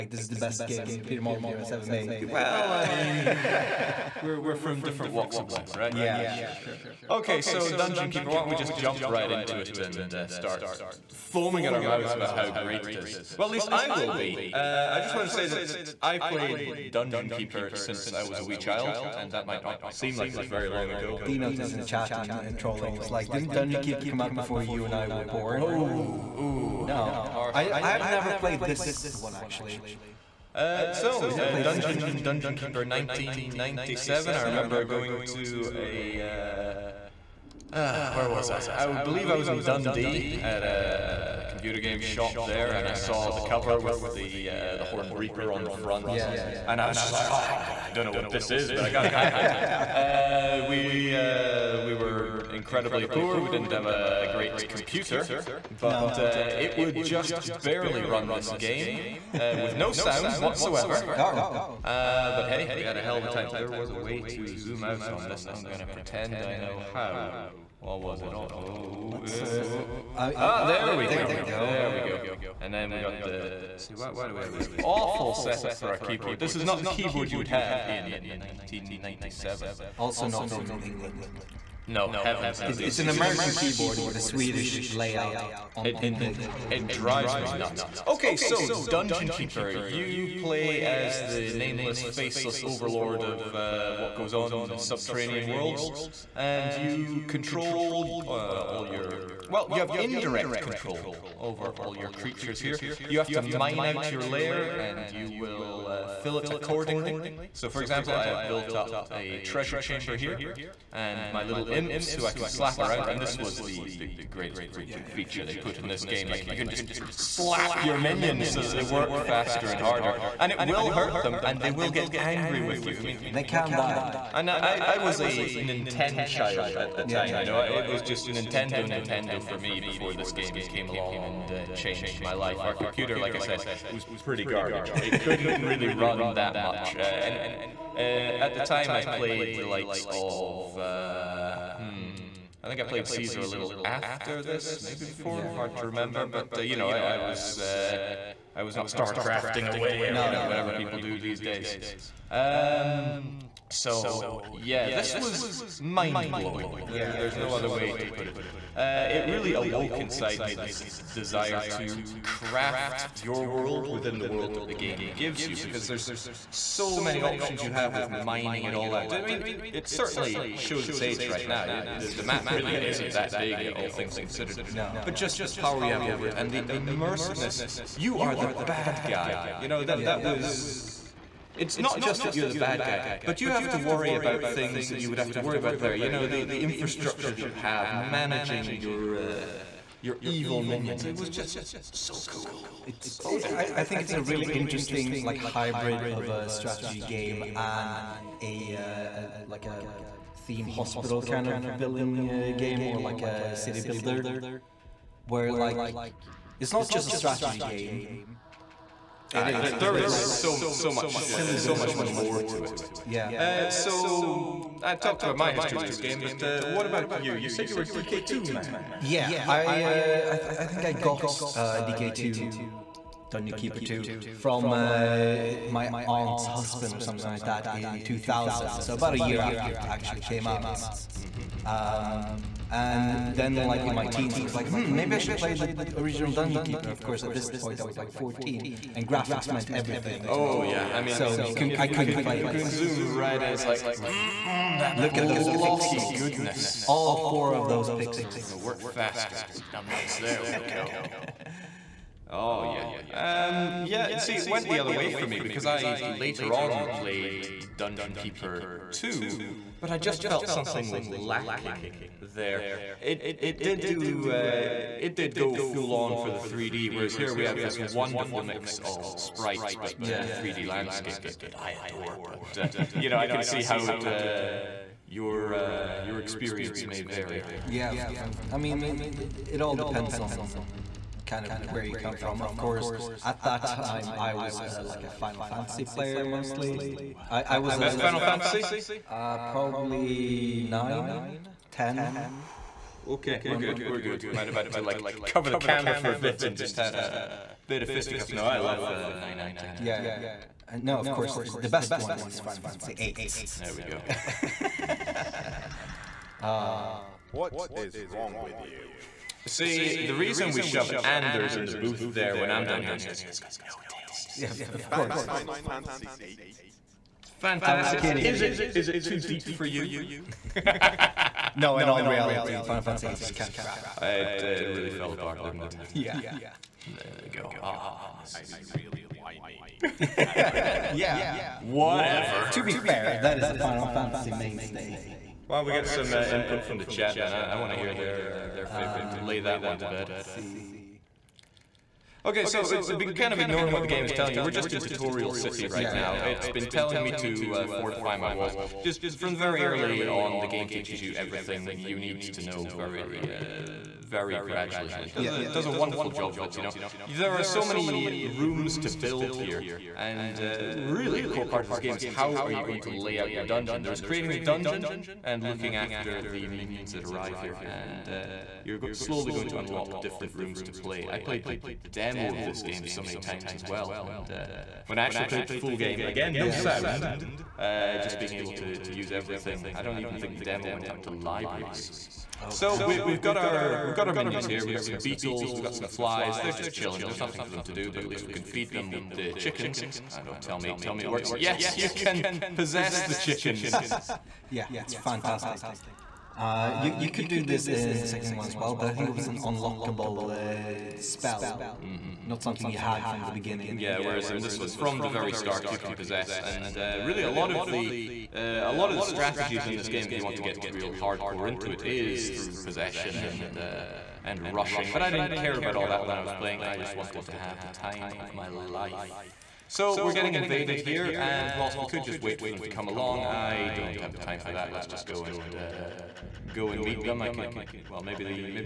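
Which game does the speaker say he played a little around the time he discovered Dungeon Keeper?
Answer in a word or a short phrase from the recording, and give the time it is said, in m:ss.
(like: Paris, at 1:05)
Caesar, at 2:23.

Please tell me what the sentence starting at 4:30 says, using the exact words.
uh, 3D landscape that, that I adore.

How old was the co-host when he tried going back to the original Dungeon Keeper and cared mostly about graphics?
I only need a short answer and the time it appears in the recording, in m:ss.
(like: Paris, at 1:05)
14, at 3:58.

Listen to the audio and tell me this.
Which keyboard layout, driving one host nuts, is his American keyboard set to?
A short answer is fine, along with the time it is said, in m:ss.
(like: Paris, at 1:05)
Swedish, at 1:24.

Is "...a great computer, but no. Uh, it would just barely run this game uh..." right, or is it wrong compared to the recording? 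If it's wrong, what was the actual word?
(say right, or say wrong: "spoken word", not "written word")
right.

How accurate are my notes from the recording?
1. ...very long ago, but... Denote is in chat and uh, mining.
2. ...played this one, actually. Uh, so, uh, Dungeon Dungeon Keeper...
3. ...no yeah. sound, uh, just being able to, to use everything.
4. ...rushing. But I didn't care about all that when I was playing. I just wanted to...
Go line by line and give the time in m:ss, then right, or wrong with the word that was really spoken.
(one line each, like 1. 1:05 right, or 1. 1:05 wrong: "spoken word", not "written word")
1. 0:20 wrong: "trolling", not "mining"
2. 0:28 right
3. 6:16 right
4. 6:54 right.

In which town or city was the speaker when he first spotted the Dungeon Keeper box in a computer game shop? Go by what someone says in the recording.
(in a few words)
Dundee.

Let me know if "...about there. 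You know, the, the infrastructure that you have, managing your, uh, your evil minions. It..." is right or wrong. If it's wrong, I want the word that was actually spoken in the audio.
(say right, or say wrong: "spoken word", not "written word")
right.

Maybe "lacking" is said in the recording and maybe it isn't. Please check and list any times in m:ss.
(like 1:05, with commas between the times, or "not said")
4:21.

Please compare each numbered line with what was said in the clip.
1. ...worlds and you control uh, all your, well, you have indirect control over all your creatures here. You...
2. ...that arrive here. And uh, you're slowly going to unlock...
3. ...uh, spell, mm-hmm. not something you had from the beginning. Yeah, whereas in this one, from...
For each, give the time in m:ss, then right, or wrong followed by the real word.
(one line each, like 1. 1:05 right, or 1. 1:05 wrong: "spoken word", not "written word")
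1. 1:35 right
2. 6:06 right
3. 6:40 right.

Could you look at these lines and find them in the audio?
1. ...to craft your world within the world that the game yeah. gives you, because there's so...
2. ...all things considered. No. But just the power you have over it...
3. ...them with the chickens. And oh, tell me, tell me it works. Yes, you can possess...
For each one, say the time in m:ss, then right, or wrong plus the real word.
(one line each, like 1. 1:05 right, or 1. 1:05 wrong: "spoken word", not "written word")
1. 2:41 right
2. 2:53 right
3. 6:28 right.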